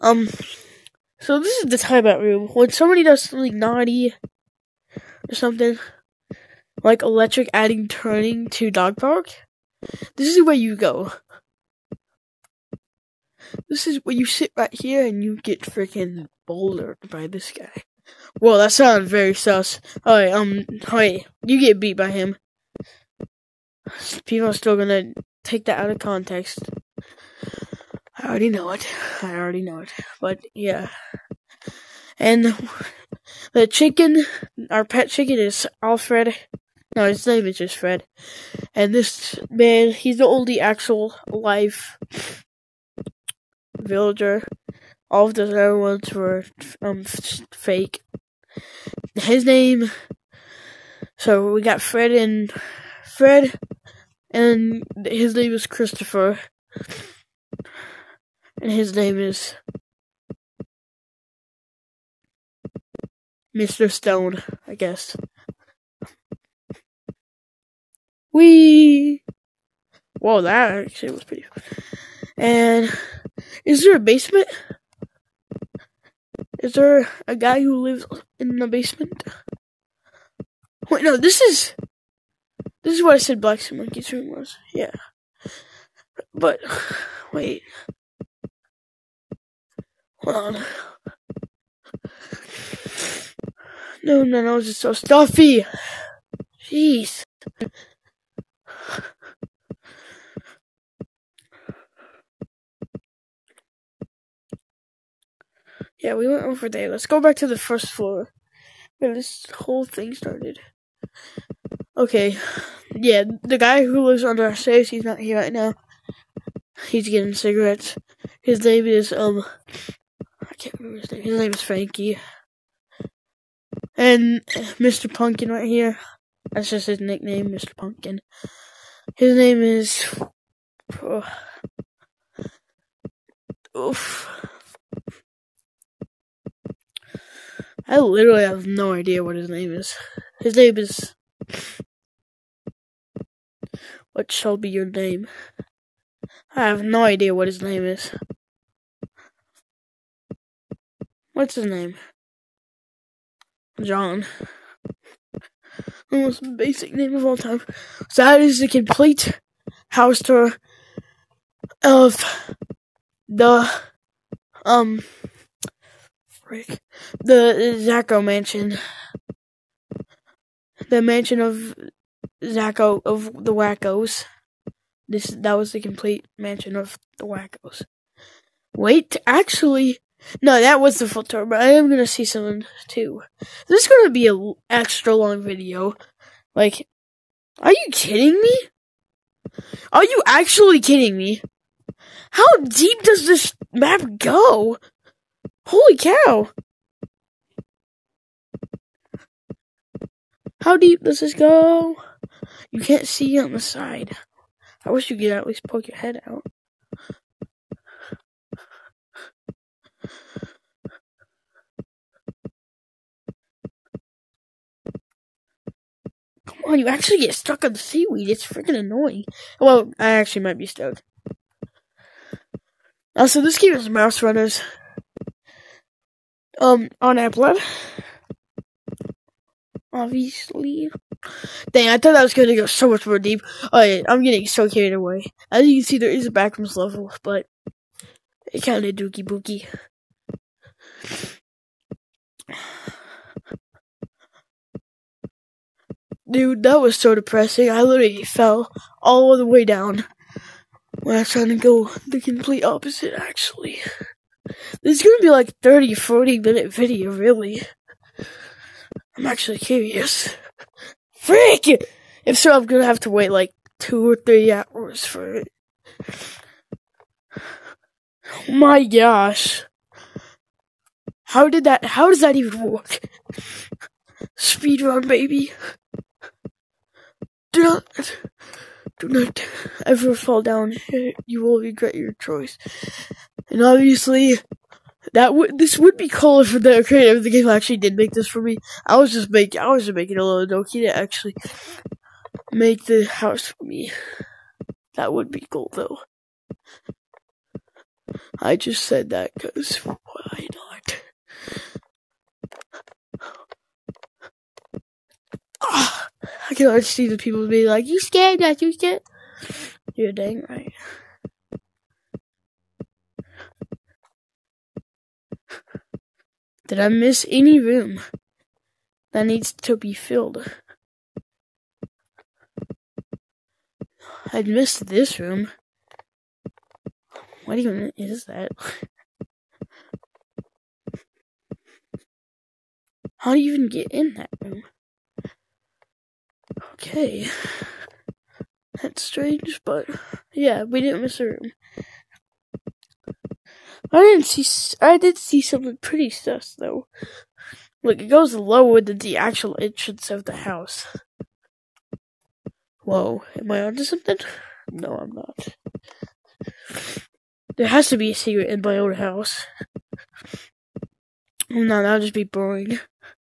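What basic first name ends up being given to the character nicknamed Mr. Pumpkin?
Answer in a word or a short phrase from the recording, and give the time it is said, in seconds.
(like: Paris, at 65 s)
John, at 153 s.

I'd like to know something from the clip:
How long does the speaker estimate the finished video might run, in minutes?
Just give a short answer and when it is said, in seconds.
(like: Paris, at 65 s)
30 to 40 minutes, at 255 s.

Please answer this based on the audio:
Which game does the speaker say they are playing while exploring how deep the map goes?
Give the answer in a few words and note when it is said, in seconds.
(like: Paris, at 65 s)
Mouse Runners, at 223 s.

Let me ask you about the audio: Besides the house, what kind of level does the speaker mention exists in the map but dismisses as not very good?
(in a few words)
backrooms level.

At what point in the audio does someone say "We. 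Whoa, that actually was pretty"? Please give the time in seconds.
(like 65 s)
68 s.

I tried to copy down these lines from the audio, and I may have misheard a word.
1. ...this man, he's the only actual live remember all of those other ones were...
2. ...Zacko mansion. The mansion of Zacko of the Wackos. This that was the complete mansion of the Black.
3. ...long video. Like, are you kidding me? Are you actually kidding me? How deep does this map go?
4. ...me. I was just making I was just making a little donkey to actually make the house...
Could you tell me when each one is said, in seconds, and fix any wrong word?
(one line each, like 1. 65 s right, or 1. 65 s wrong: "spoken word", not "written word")
1. 38 s wrong: "villager", not "remember"
2. 167 s wrong: "Wackos", not "Black"
3. 185 s right
4. 288 s right.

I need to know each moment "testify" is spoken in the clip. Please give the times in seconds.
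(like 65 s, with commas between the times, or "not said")
not said.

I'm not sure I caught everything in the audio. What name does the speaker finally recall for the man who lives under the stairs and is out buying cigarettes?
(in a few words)
Frankie.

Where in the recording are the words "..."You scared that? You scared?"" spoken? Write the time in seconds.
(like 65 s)
307 s.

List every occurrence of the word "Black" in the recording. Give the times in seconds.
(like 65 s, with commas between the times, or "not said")
83 s.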